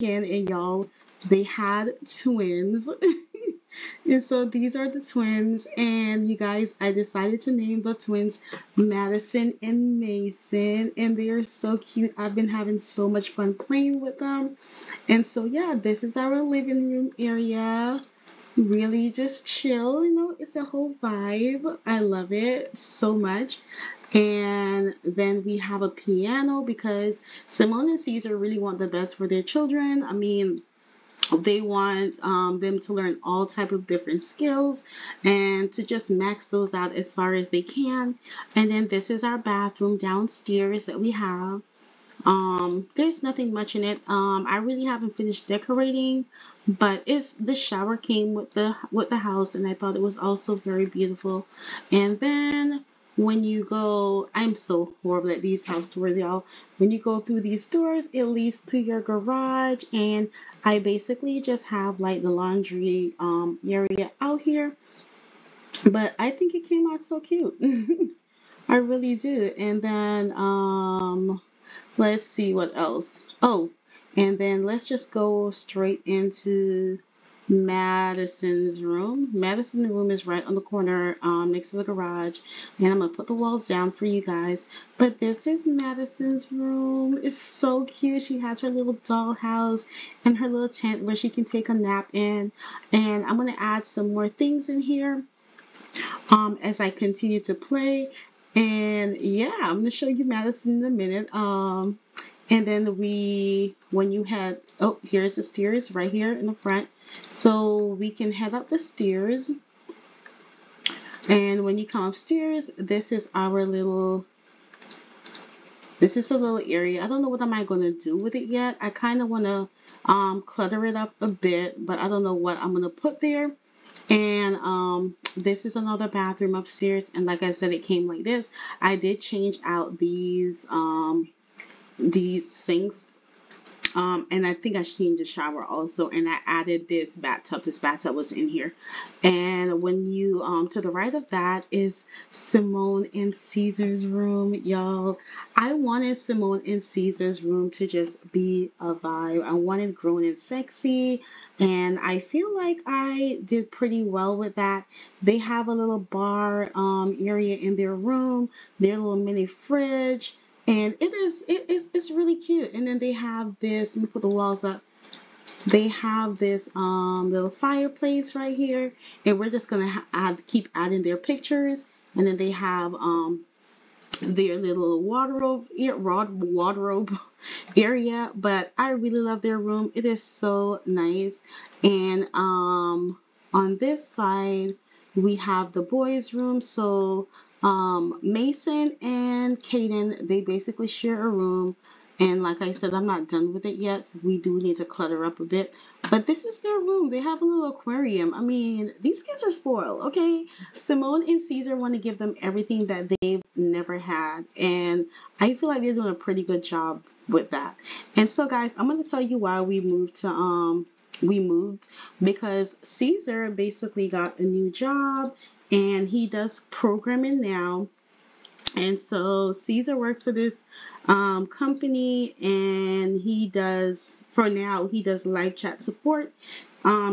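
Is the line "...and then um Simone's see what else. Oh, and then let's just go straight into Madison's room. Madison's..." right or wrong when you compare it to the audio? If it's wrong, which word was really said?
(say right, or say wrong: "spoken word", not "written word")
wrong: "Let", not "Simone".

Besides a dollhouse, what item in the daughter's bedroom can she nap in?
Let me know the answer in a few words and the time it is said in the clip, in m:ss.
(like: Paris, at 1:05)
Tent, at 1:30.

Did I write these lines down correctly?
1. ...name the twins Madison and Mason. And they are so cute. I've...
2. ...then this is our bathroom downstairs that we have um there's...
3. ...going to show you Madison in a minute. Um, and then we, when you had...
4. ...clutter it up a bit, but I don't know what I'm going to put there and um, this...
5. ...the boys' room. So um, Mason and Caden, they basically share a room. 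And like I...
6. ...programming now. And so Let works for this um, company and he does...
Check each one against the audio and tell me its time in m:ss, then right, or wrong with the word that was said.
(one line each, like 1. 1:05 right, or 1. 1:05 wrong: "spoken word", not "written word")
1. 0:07 right
2. 0:38 right
3. 1:39 right
4. 2:00 right
5. 3:05 right
6. 3:36 wrong: "Caesar", not "Let".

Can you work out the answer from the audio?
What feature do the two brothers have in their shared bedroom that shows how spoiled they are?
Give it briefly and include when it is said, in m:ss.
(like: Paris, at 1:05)
Aquarium, at 3:17.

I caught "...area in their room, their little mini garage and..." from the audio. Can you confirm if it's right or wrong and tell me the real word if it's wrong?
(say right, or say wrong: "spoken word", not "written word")
wrong: "fridge", not "garage".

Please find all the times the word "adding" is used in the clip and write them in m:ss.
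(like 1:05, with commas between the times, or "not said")
2:50.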